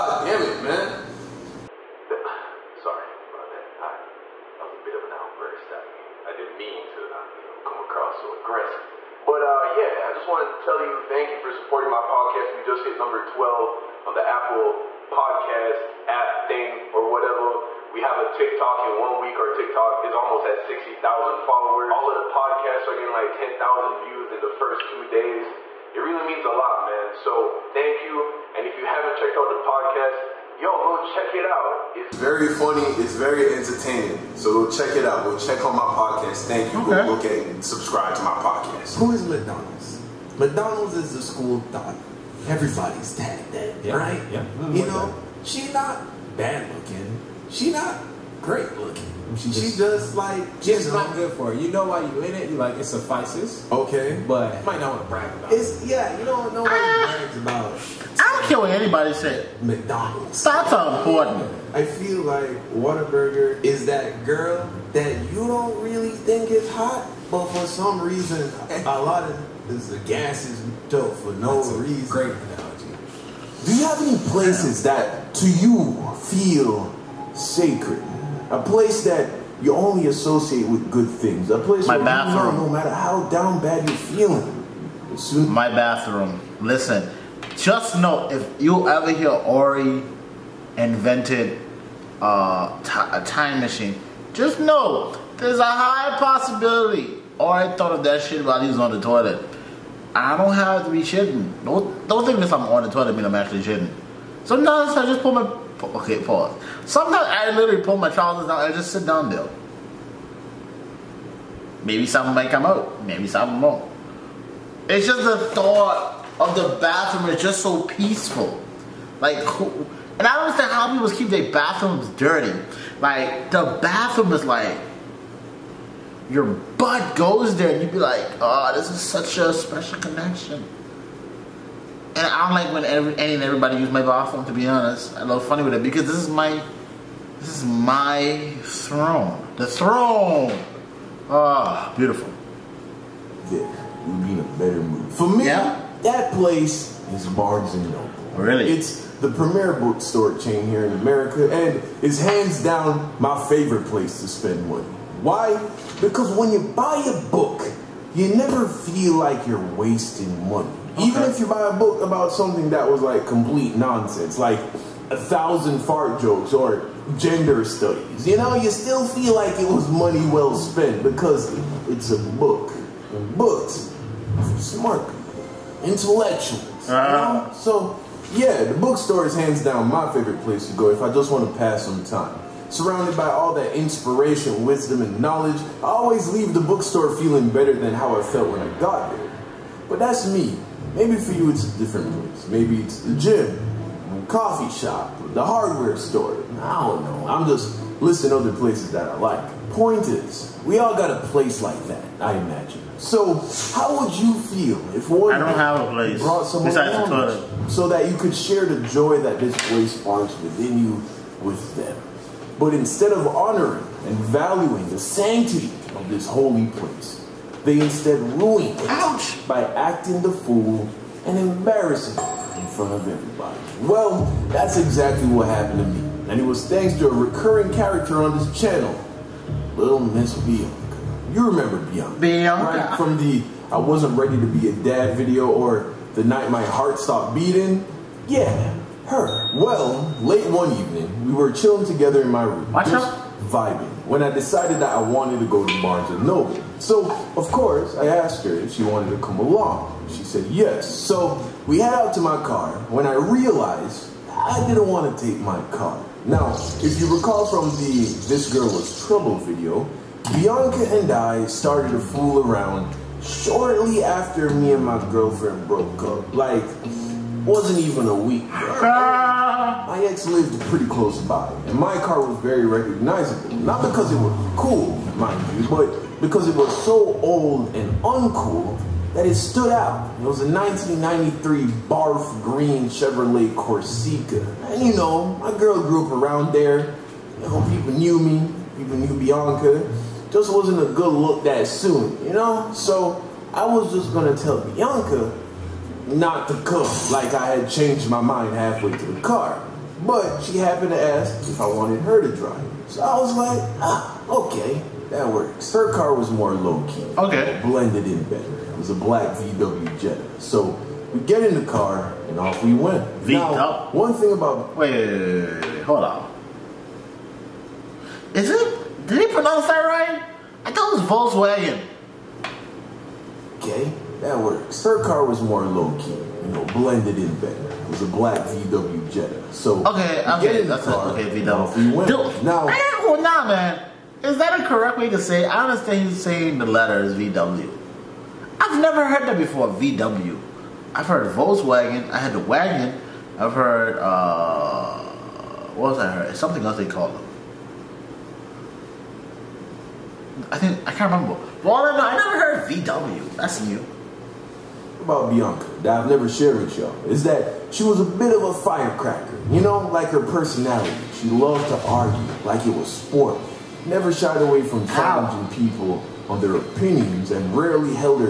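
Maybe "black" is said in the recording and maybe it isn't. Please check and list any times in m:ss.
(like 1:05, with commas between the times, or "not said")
5:08, 5:28.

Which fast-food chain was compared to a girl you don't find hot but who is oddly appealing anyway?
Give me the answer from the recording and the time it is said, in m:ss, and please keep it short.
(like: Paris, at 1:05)
Whataburger, at 1:02.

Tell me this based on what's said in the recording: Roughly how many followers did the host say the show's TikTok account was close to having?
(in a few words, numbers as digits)
60,000.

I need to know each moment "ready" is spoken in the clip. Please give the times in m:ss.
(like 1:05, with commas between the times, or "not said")
3:54.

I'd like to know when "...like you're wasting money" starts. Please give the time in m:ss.
2:39.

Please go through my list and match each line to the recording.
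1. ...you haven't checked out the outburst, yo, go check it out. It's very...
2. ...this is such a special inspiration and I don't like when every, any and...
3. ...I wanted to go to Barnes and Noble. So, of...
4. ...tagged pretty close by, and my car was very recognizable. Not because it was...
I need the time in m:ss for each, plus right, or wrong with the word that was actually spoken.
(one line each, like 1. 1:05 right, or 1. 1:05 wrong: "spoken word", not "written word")
1. 0:28 wrong: "podcast", not "outburst"
2. 2:08 wrong: "connection", not "inspiration"
3. 4:04 right
4. 4:30 wrong: "lived", not "tagged".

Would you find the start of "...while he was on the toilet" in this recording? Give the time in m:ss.
1:38.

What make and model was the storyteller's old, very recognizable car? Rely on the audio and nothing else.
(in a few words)
Chevrolet Corsica.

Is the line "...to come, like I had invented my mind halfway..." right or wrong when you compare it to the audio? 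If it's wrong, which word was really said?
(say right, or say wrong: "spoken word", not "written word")
wrong: "changed", not "invented".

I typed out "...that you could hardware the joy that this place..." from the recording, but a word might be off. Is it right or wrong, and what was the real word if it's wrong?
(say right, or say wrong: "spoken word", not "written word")
wrong: "share", not "hardware".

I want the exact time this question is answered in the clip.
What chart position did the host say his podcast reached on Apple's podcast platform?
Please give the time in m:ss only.
0:12.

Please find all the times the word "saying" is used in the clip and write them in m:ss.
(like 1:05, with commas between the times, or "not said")
5:36.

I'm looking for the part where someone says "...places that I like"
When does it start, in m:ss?
3:18.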